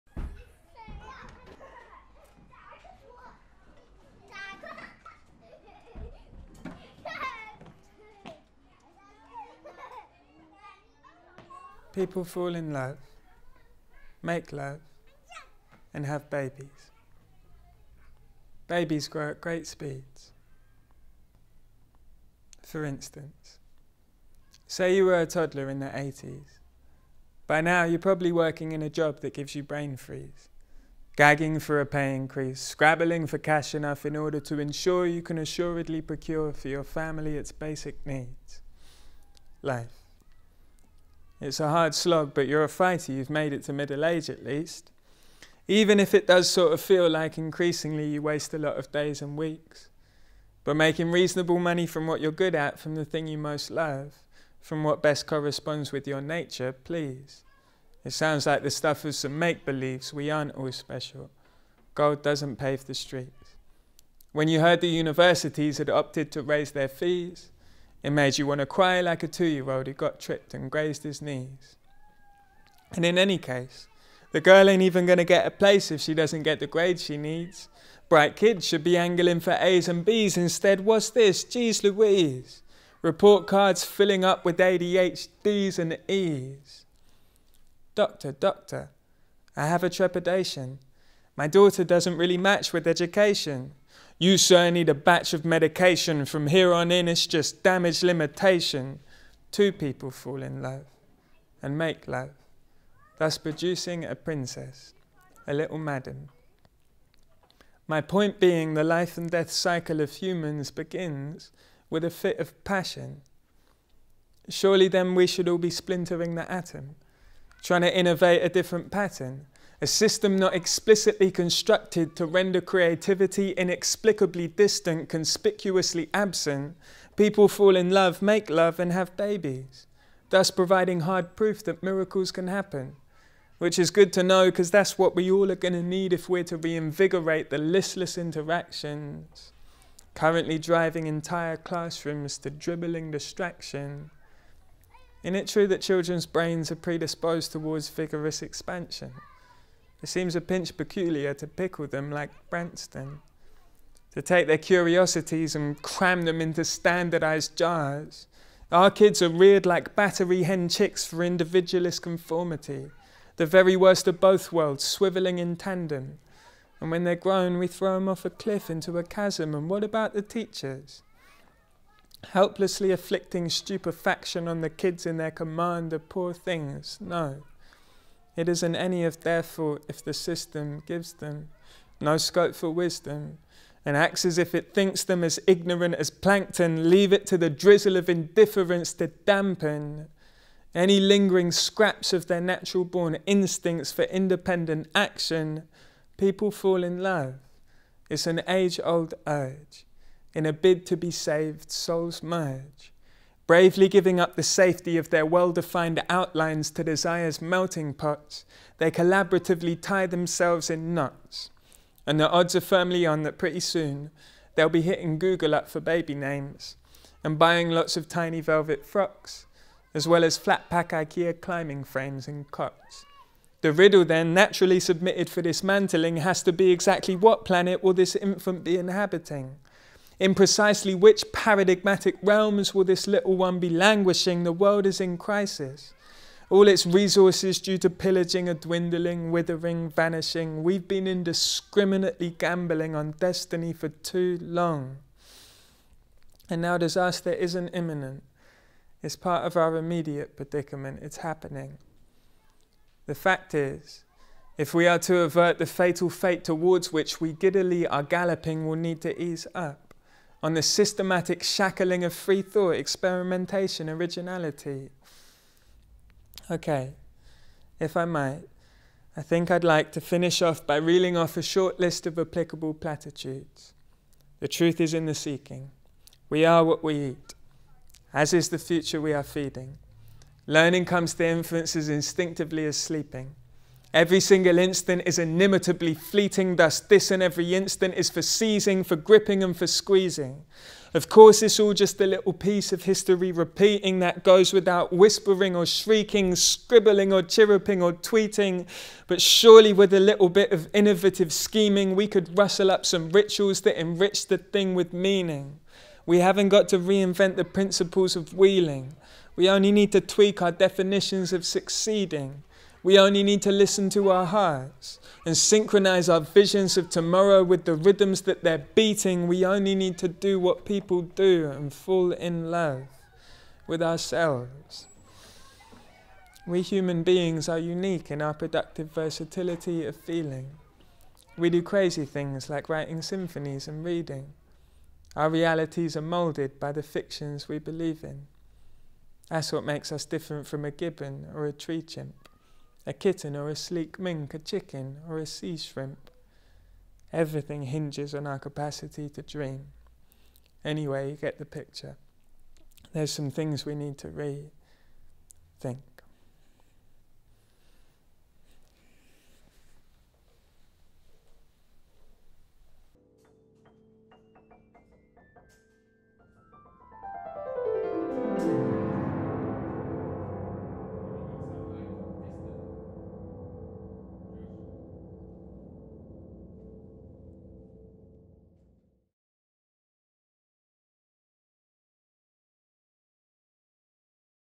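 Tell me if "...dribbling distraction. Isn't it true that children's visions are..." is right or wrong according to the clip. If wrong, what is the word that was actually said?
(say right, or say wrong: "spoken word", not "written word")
wrong: "brains", not "visions".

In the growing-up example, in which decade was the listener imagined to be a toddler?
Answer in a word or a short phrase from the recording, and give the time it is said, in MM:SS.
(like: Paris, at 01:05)
the 80s, at 00:25.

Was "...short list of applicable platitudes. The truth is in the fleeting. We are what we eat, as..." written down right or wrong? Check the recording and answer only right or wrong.
wrong.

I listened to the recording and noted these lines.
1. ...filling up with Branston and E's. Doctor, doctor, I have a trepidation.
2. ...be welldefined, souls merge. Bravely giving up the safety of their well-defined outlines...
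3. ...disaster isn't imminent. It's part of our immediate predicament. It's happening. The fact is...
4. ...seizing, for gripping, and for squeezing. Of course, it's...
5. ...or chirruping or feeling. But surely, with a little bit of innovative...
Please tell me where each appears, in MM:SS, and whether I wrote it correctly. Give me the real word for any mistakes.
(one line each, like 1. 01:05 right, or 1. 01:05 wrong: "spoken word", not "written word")
1. 01:23 wrong: "ADHDs", not "Branston"
2. 03:20 wrong: "saved", not "welldefined"
3. 04:06 right
4. 04:48 right
5. 04:57 wrong: "tweeting", not "feeling".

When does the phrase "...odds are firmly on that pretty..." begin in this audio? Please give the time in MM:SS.
03:32.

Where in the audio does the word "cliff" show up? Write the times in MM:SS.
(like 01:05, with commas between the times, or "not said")
02:48.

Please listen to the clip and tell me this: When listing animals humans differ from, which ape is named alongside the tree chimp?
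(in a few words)
gibbon.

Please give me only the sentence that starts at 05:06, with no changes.
We haven't got to reinvent the principles of wheeling.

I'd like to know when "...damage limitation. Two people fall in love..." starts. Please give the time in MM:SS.
01:37.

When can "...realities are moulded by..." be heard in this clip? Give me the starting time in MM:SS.
05:35.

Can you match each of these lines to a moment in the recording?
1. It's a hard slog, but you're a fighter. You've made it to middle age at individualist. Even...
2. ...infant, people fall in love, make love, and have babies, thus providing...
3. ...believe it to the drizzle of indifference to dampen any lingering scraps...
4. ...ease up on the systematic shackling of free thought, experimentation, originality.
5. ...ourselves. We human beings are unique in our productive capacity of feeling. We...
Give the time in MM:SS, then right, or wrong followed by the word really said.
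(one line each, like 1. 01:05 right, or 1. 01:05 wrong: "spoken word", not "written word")
1. 00:41 wrong: "least", not "individualist"
2. 02:06 wrong: "absent", not "infant"
3. 03:06 wrong: "leave", not "believe"
4. 04:19 right
5. 05:23 wrong: "versatility", not "capacity".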